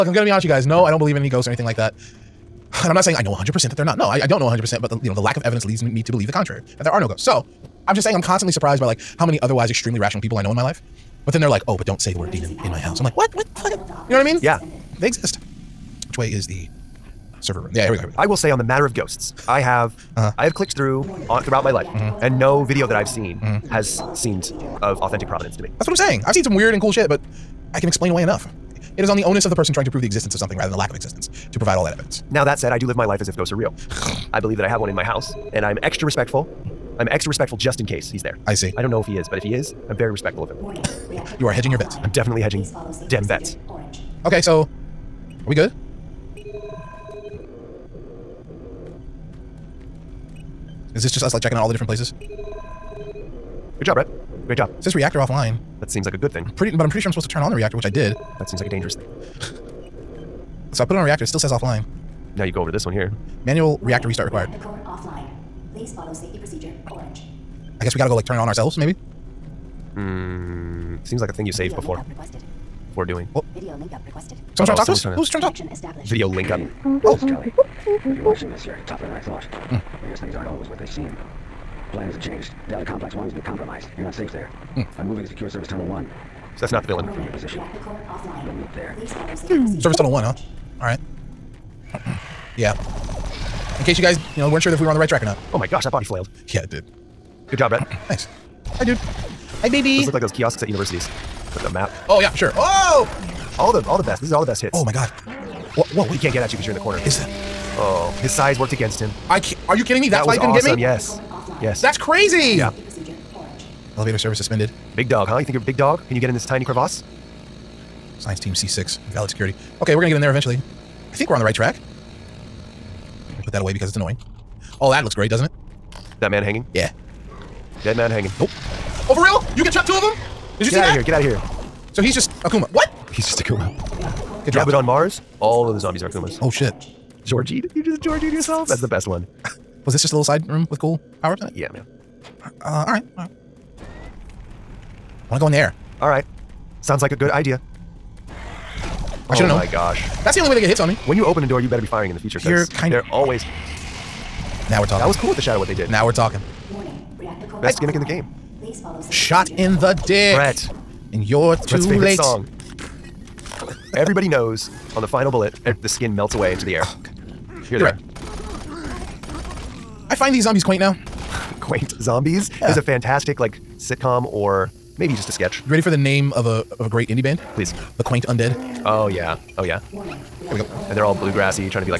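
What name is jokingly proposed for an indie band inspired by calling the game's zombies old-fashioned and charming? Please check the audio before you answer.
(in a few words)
The Quaint Undead.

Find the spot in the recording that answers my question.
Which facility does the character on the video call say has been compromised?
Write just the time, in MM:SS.
01:22.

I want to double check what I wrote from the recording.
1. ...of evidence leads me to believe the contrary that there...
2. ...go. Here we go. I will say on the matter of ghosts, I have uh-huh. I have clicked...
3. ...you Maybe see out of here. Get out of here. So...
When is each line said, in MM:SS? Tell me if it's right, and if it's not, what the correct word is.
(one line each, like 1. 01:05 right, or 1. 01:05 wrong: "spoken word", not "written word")
1. 00:05 right
2. 00:17 right
3. 02:10 wrong: "Get", not "Maybe".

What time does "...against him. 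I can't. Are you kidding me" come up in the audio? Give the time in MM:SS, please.
01:48.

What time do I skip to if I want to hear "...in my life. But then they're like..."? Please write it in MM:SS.
00:10.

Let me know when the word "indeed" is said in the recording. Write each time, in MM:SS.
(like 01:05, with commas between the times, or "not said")
not said.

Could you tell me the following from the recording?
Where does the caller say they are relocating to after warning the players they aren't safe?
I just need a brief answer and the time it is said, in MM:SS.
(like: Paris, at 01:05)
Secure service tunnel 1, at 01:25.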